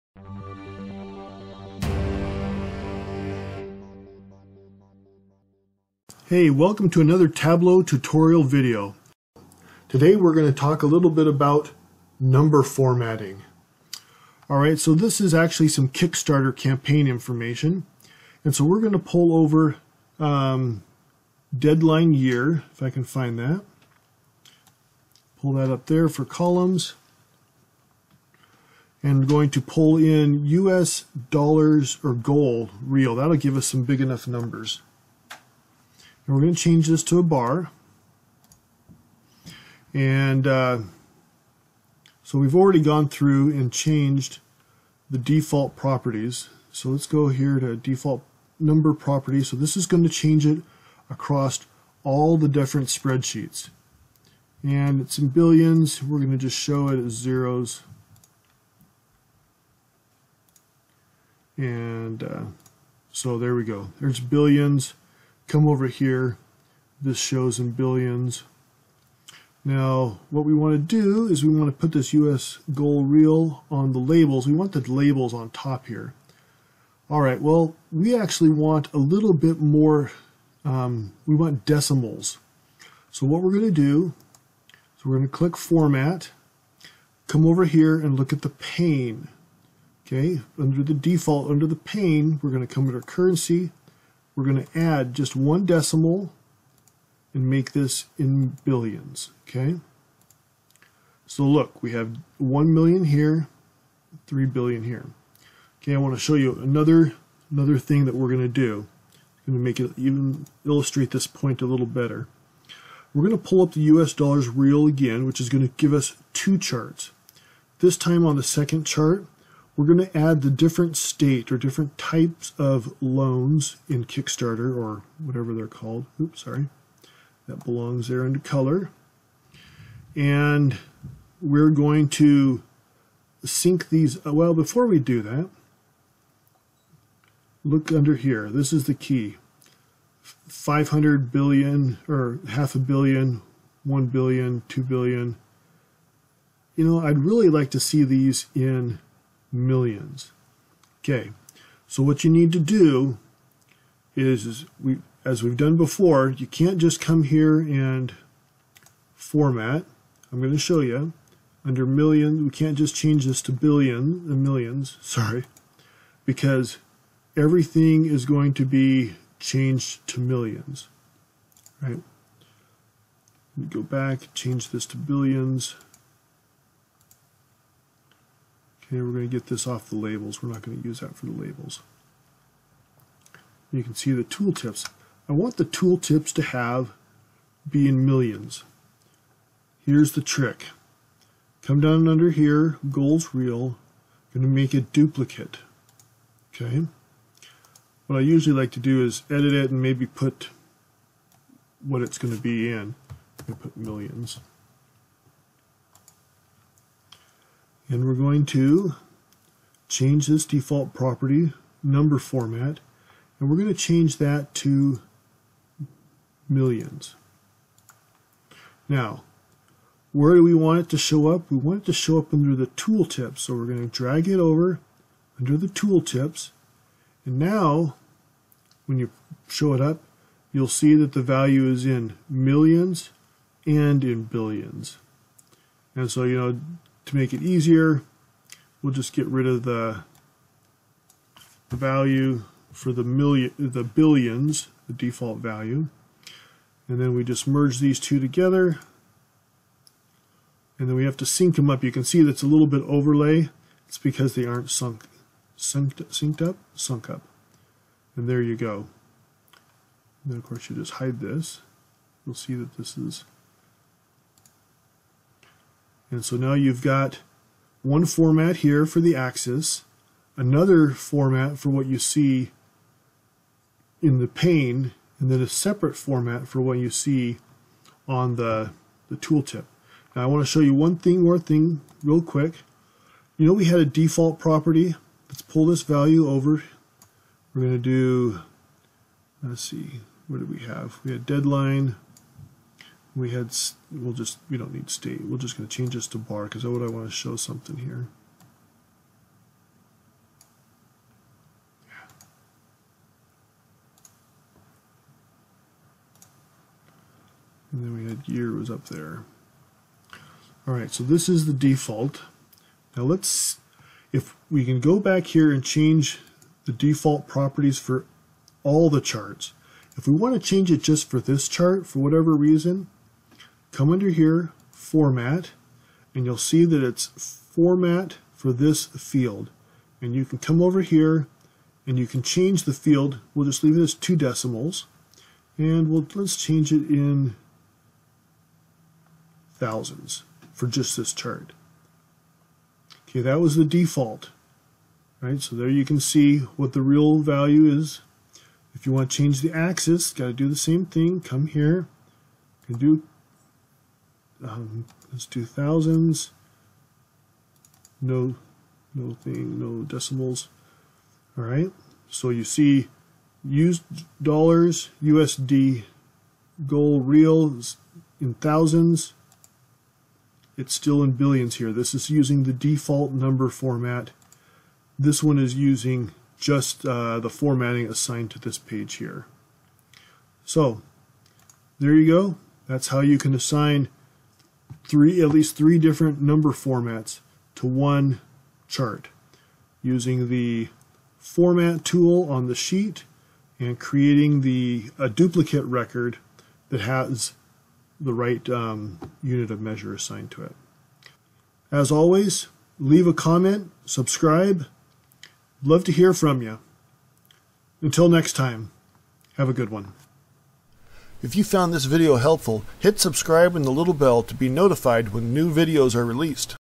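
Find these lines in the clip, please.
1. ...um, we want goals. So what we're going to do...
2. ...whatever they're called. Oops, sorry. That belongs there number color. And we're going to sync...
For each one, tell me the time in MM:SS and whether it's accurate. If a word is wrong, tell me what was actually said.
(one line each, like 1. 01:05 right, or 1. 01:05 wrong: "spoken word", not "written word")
1. 01:20 wrong: "decimals", not "goals"
2. 02:05 wrong: "under", not "number".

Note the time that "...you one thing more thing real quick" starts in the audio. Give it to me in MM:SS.
04:40.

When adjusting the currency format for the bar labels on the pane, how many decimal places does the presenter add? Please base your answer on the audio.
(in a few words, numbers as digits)
1.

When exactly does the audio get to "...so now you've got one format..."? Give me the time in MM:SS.
04:26.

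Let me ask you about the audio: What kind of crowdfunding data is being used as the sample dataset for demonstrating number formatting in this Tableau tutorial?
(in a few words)
Kickstarter campaign information.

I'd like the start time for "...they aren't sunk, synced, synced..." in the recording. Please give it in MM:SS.
04:14.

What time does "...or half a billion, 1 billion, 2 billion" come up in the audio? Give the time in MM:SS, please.
02:22.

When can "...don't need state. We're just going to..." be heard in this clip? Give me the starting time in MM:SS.
04:54.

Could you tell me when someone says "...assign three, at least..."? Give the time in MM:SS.
06:23.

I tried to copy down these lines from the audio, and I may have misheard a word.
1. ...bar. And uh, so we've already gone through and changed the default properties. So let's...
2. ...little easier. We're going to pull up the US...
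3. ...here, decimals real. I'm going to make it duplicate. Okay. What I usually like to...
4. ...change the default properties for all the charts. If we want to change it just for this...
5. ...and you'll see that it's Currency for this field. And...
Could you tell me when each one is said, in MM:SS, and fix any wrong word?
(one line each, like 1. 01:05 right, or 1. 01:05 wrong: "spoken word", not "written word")
1. 00:37 right
2. 01:51 wrong: "better", not "easier"
3. 03:12 wrong: "goals", not "decimals"
4. 05:15 right
5. 05:26 wrong: "Format", not "Currency".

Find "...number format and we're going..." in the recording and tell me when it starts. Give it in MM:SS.
03:31.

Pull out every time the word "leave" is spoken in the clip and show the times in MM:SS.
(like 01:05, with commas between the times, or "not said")
05:33, 06:42.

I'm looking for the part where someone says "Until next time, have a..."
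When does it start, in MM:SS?
06:47.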